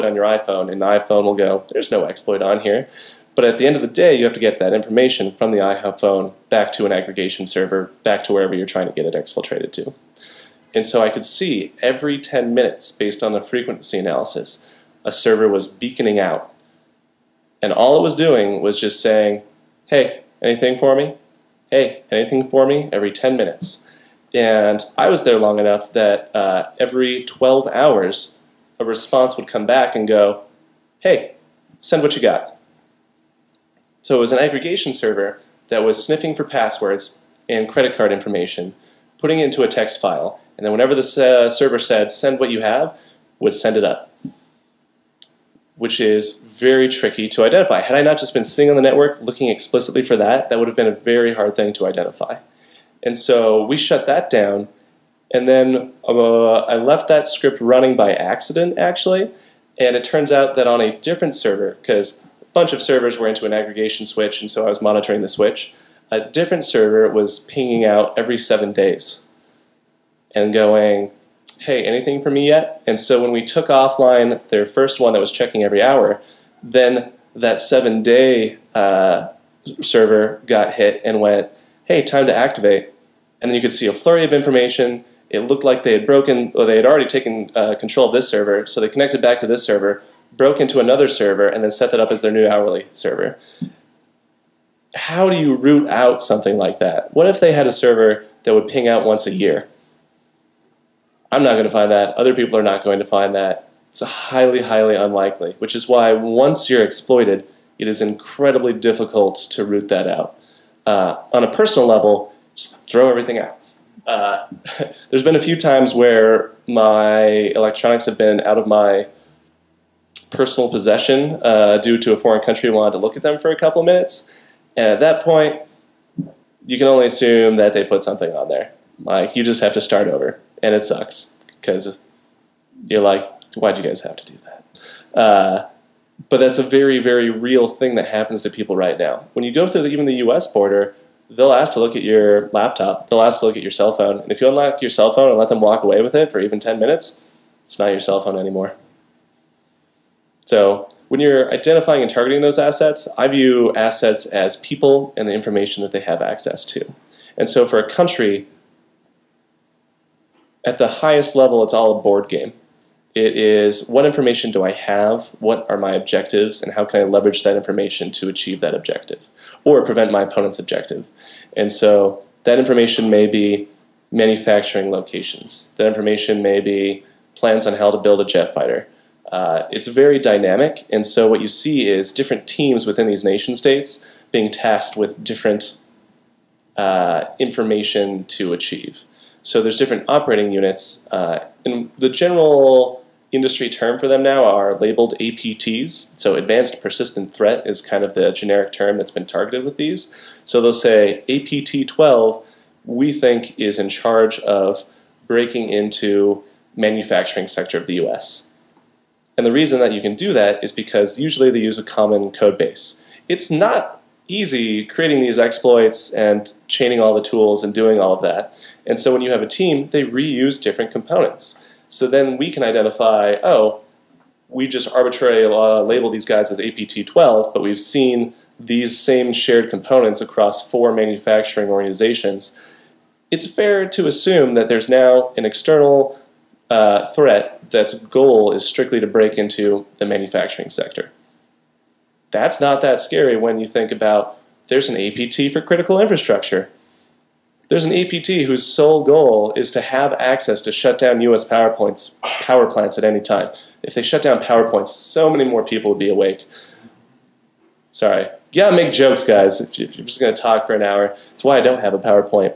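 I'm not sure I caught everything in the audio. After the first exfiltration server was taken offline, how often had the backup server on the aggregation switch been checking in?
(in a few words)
Every 7 days.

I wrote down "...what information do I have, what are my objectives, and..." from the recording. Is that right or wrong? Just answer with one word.
right.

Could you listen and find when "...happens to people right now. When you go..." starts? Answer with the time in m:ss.
2:18.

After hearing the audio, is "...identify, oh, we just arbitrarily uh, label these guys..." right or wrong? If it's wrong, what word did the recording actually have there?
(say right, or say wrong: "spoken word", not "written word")
right.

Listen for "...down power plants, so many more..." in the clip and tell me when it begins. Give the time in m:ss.
4:14.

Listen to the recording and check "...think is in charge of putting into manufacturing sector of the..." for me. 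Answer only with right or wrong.
wrong.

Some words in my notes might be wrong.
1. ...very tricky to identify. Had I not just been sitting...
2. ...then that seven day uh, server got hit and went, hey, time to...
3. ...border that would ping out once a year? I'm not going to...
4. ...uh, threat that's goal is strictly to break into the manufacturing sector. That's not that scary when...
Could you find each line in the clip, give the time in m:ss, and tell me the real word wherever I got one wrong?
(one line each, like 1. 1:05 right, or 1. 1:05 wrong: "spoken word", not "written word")
1. 0:46 right
2. 1:16 right
3. 1:37 wrong: "server", not "border"
4. 3:56 right.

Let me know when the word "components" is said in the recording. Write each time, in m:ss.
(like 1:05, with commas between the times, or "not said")
3:40, 3:49.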